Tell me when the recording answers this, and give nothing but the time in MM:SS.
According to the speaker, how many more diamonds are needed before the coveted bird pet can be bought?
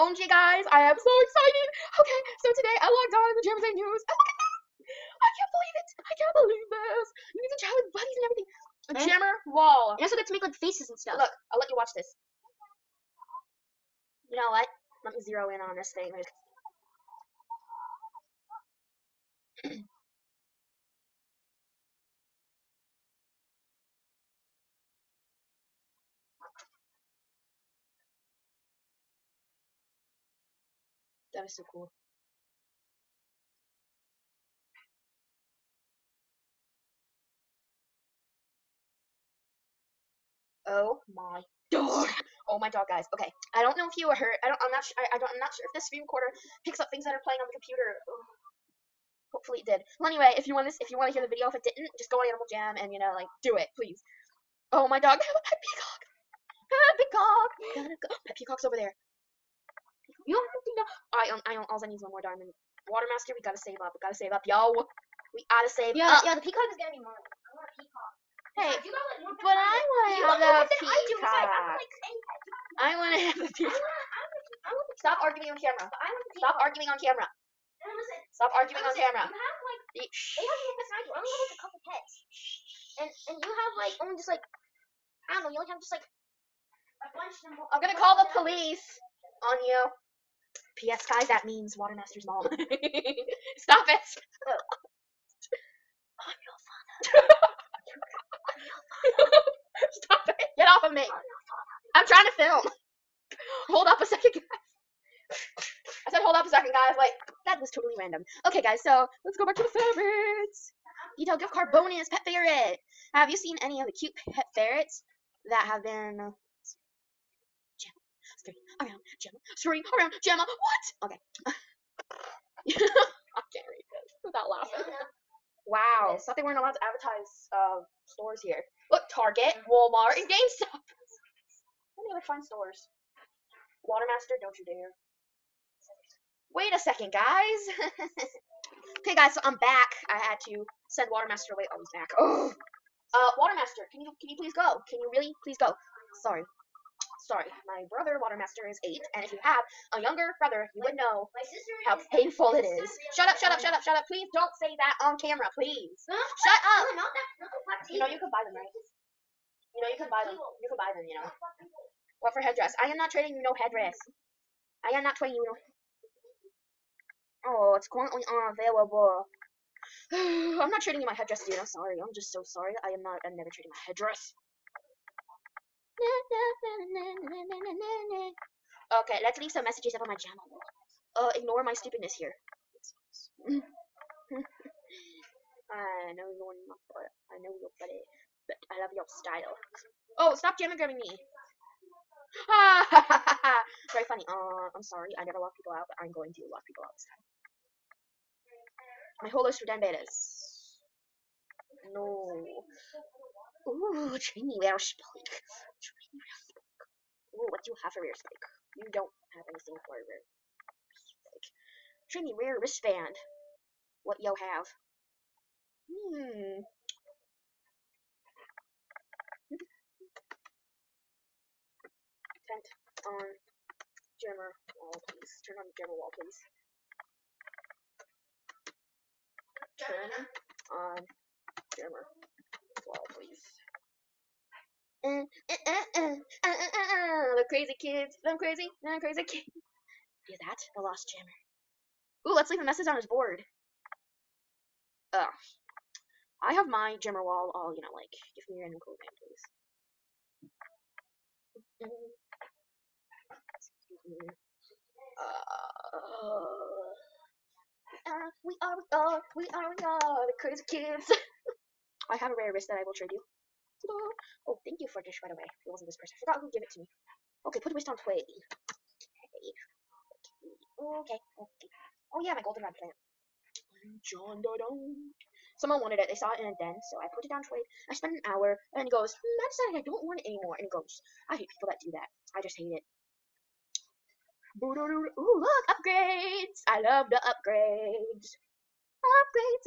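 01:02.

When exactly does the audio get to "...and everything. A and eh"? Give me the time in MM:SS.
00:08.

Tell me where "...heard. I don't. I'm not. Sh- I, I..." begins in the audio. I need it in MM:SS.
00:44.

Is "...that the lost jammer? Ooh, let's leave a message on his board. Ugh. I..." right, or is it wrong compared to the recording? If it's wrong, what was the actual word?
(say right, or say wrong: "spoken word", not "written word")
right.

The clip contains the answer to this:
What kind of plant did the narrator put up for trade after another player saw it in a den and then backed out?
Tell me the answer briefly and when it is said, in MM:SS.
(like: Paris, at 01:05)
goldenrod plant, at 04:32.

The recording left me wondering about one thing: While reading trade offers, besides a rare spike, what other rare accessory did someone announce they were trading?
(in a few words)
rare wristband.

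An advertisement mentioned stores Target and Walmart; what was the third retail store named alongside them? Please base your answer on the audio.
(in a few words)
GameStop.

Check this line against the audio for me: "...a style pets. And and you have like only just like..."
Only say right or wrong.
wrong.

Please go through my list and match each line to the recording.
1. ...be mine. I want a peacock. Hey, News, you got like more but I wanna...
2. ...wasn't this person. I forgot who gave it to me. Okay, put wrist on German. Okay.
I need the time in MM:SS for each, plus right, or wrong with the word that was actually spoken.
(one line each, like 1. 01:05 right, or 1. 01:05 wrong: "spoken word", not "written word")
1. 01:06 wrong: "Besides", not "News"
2. 04:25 wrong: "Tway", not "German".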